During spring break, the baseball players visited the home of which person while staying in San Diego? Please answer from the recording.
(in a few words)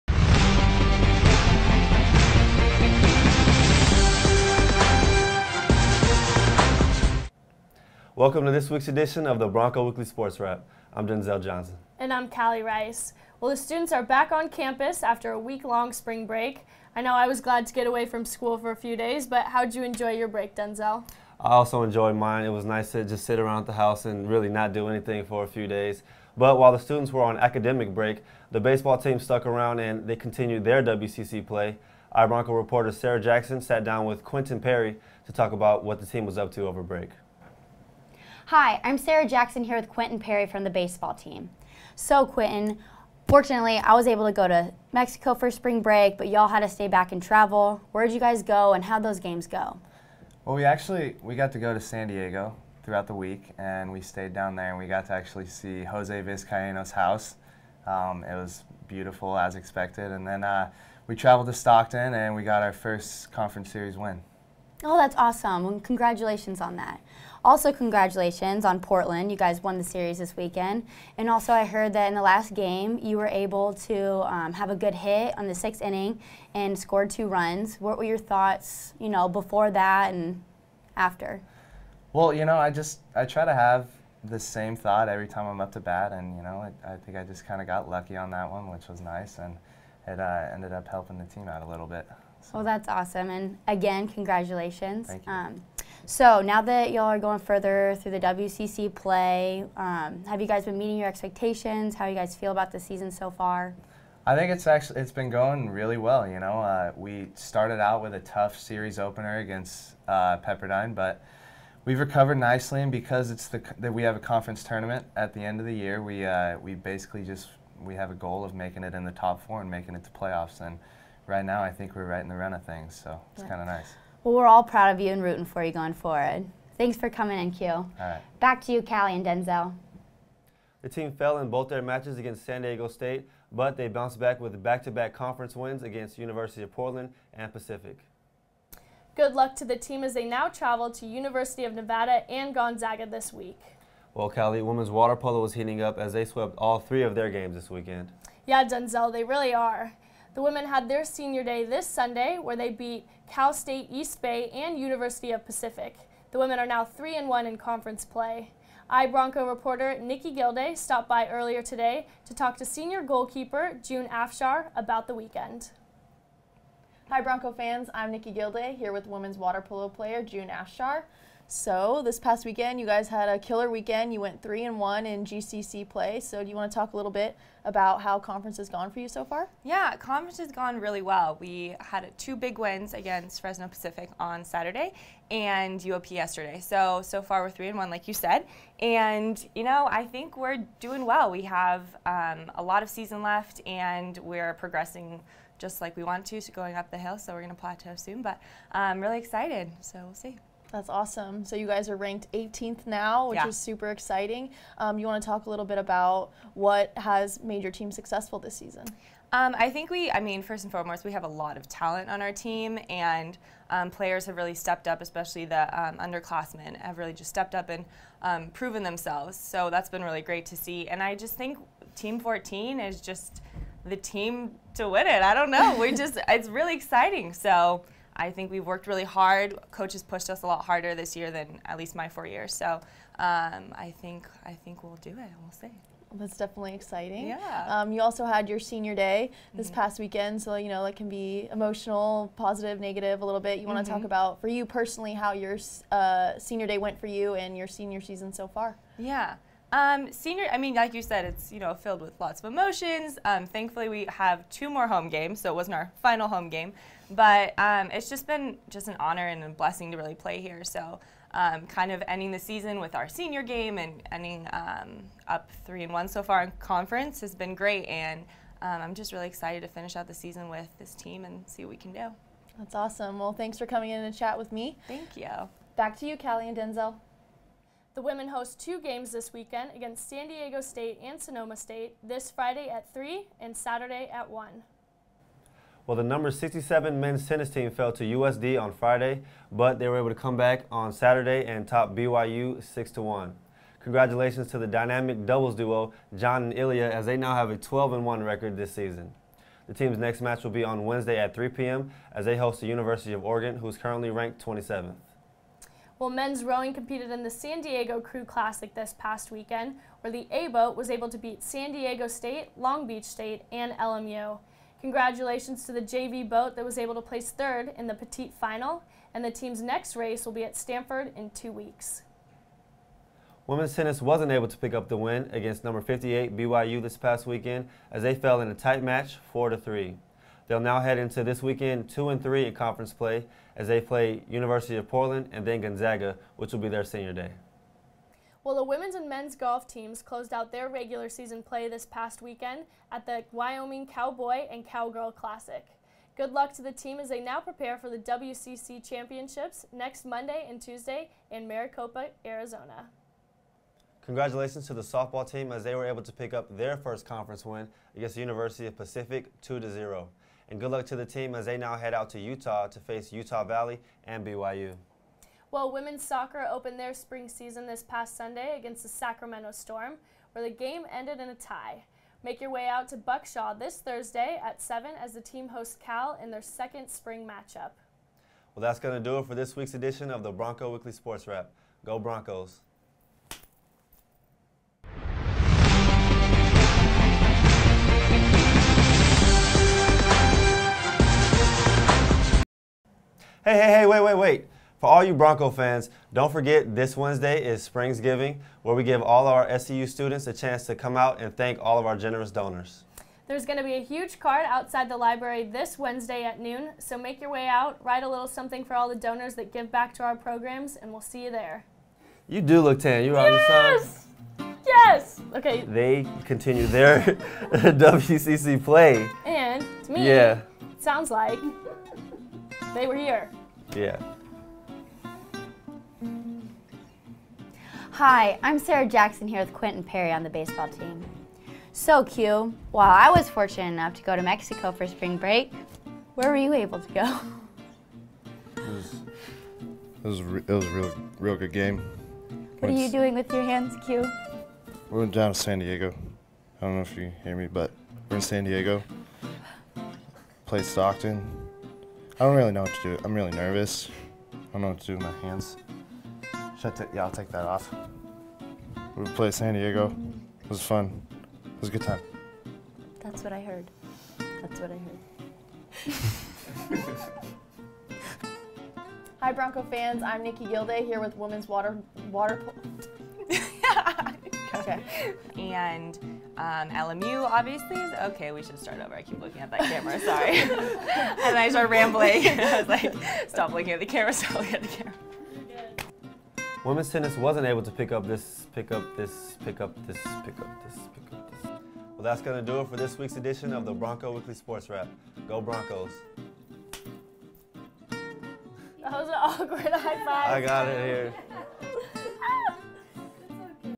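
Jose Vizcaino.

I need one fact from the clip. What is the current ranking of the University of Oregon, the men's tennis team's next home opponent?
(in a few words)
27th.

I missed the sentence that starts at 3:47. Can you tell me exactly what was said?
So I think we've worked really hard.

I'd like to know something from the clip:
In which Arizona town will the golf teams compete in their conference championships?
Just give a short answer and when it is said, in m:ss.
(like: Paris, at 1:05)
Maricopa, at 5:51.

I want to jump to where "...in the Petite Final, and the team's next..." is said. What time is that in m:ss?
5:17.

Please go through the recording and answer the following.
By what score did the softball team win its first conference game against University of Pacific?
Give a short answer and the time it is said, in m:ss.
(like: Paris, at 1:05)
2-0, at 5:59.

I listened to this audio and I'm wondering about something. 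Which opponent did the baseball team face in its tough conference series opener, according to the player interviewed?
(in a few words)
Pepperdine.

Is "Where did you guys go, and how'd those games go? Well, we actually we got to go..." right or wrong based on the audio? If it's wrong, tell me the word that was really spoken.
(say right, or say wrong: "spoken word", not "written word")
right.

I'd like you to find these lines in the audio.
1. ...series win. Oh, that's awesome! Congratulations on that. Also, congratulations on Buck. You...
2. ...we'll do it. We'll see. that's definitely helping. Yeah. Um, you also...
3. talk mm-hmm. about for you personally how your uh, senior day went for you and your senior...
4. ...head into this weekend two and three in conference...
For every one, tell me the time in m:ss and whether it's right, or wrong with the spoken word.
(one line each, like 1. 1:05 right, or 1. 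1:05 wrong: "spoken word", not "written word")
1. 1:03 wrong: "Portland", not "Buck"
2. 3:54 wrong: "exciting", not "helping"
3. 4:04 right
4. 5:30 right.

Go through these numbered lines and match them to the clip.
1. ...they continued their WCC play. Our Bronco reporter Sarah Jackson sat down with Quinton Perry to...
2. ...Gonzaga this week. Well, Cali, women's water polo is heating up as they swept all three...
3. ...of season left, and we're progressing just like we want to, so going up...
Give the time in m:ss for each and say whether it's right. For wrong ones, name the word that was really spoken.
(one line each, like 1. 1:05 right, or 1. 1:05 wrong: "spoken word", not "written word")
1. 0:30 right
2. 2:22 right
3. 3:12 right.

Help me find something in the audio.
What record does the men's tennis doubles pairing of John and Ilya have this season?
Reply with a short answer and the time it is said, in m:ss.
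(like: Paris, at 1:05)
12 and 1, at 4:57.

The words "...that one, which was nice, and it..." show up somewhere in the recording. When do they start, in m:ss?
1:28.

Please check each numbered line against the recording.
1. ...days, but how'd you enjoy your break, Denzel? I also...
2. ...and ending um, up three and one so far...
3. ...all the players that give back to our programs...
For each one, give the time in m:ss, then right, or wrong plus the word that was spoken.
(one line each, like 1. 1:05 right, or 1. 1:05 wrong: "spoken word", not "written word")
1. 0:18 right
2. 4:23 right
3. 6:48 wrong: "donors", not "players".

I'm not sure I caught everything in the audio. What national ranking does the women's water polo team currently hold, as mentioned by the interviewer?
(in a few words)
18th.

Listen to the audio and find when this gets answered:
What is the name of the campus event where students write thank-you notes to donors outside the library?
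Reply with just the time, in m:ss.
6:37.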